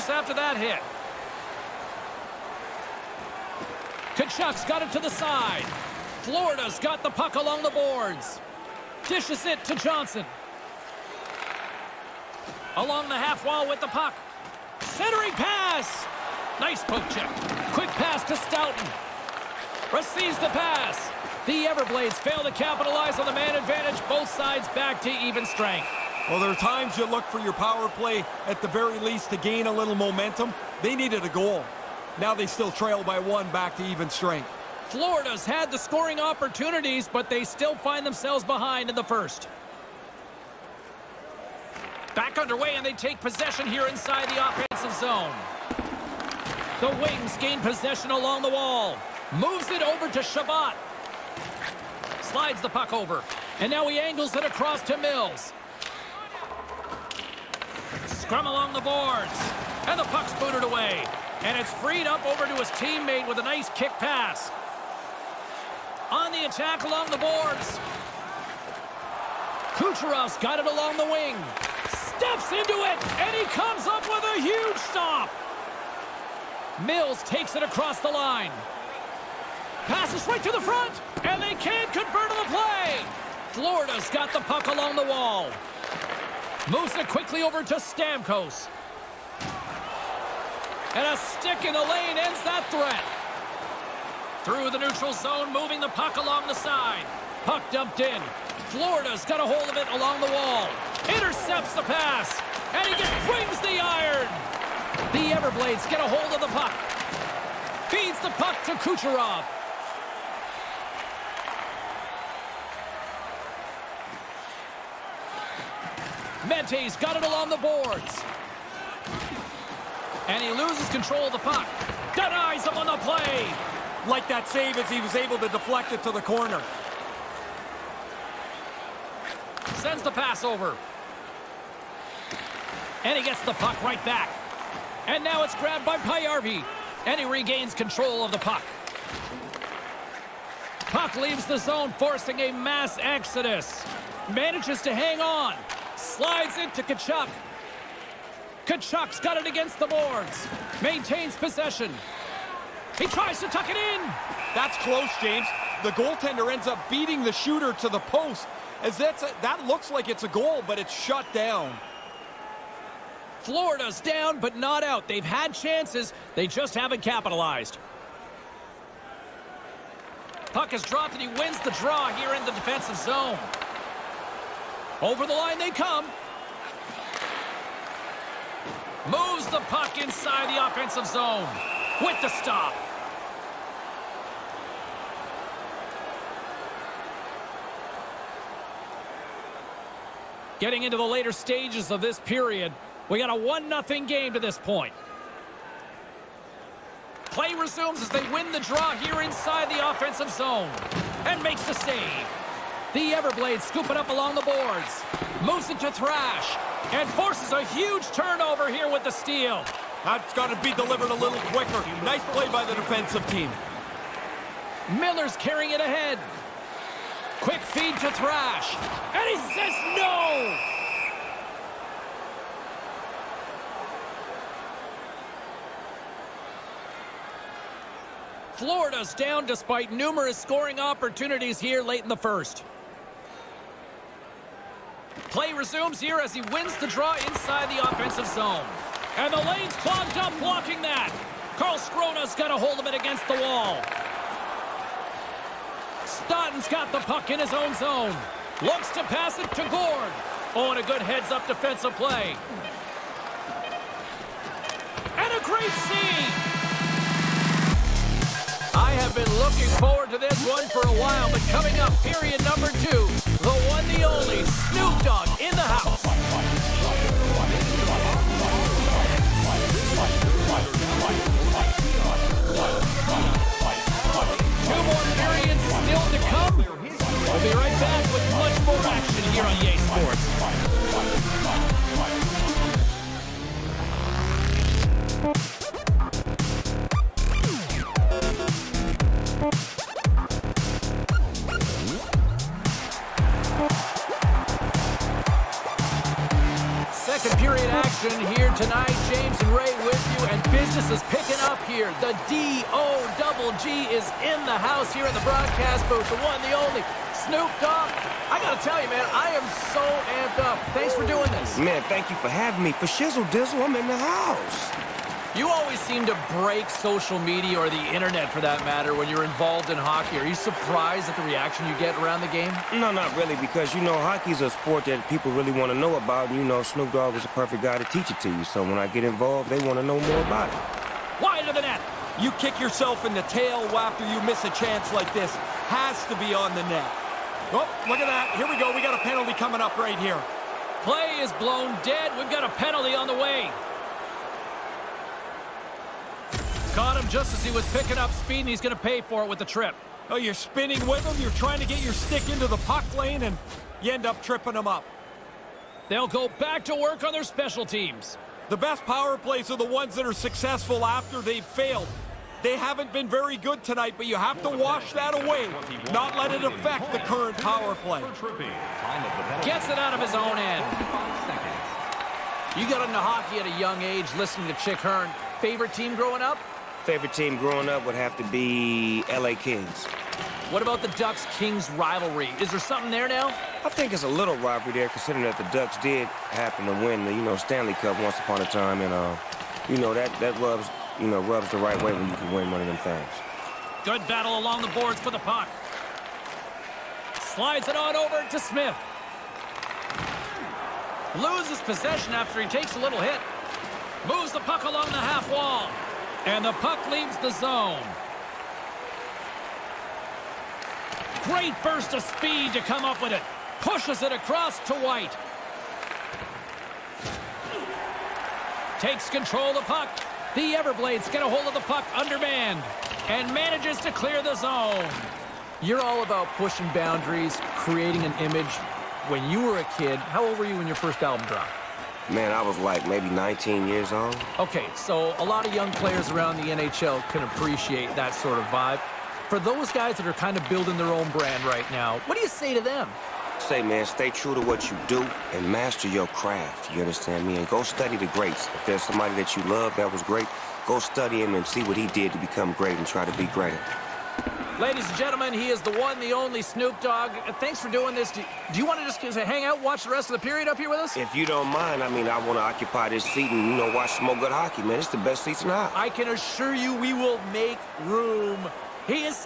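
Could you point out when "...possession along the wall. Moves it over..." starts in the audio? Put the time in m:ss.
0:47.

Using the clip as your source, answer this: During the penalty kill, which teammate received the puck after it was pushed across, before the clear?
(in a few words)
White.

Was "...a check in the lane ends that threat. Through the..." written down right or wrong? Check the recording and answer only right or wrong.
wrong.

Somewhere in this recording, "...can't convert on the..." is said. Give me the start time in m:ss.
1:21.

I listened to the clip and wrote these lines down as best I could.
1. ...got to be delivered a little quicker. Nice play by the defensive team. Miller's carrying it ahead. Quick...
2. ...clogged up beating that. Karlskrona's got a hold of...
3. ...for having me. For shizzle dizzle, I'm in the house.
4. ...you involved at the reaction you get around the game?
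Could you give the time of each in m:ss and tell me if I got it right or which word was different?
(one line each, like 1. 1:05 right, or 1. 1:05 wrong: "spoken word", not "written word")
1. 3:30 right
2. 3:59 wrong: "blocking", not "beating"
3. 5:12 right
4. 5:20 wrong: "surprised", not "involved".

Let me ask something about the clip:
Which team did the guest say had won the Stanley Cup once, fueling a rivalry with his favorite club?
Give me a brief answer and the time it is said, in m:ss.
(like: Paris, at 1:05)
Ducks, at 6:25.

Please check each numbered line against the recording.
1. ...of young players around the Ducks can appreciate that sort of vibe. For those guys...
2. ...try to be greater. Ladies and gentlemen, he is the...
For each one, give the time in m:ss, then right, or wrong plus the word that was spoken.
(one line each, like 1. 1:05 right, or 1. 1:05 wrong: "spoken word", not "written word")
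1. 7:15 wrong: "NHL", not "Ducks"
2. 7:32 right.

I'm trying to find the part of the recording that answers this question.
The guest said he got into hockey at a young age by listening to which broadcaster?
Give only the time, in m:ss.
6:14.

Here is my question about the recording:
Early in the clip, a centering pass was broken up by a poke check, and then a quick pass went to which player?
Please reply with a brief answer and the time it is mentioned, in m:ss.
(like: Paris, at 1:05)
Stoughton, at 0:18.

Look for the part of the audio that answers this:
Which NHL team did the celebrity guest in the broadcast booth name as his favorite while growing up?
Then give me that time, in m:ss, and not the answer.
6:19.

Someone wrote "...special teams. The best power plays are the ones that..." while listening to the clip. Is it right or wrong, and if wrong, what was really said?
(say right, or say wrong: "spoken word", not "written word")
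right.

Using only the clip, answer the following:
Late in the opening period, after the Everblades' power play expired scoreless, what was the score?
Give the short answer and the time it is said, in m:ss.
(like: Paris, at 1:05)
1-0, at 3:13.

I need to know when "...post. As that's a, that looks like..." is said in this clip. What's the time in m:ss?
2:37.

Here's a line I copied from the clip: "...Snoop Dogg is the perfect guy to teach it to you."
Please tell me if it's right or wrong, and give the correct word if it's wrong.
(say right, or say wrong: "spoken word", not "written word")
right.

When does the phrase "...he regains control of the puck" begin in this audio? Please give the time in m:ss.
2:17.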